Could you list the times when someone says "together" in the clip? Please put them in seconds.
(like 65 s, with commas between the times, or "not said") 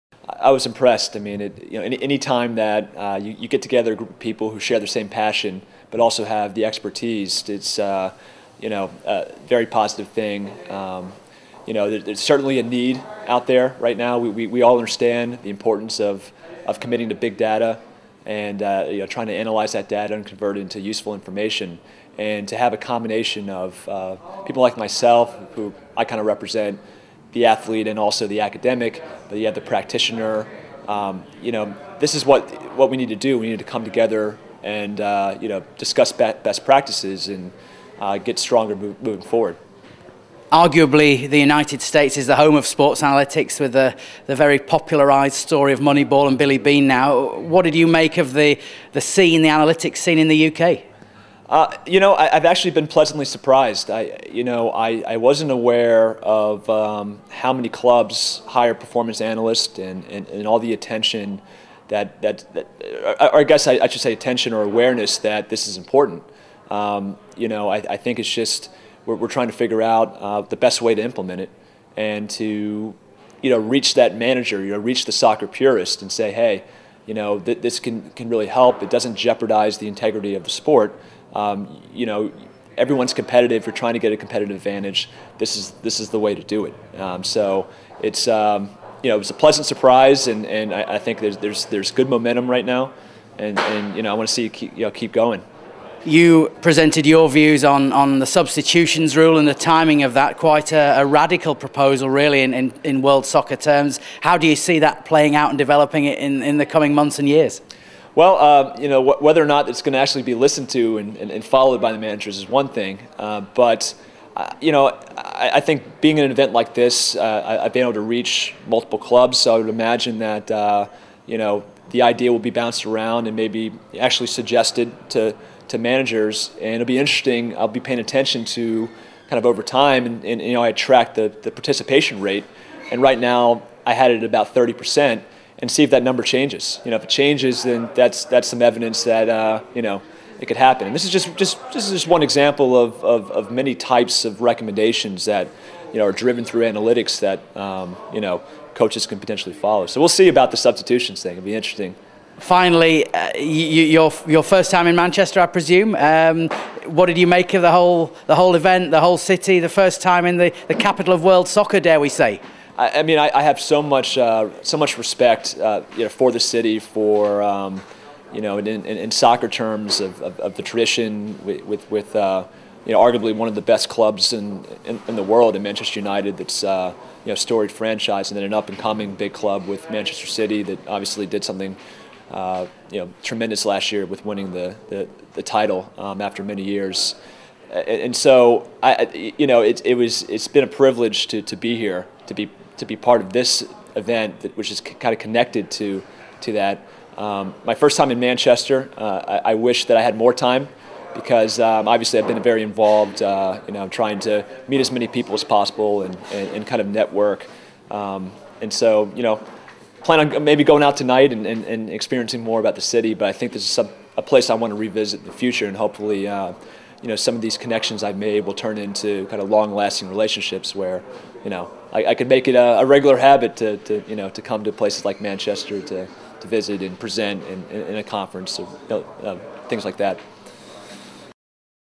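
3 s, 33 s.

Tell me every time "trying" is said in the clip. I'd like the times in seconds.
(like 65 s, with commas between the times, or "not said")
19 s, 69 s, 83 s, 203 s.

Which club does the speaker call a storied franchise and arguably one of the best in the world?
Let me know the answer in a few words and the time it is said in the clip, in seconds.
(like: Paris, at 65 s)
Manchester United, at 175 s.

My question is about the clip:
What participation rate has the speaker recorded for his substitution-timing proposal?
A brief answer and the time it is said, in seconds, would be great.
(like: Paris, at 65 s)
30%, at 134 s.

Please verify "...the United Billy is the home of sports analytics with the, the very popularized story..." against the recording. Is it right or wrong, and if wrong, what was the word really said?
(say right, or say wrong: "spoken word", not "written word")
wrong: "States", not "Billy".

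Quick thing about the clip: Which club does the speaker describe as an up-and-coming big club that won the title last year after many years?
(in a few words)
Manchester City.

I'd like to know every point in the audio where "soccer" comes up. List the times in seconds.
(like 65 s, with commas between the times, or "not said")
75 s, 103 s, 161 s, 169 s.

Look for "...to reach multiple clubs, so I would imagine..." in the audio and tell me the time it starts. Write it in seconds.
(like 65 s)
117 s.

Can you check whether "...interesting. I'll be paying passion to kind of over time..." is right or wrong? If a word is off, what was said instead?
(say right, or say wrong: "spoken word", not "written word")
wrong: "attention", not "passion".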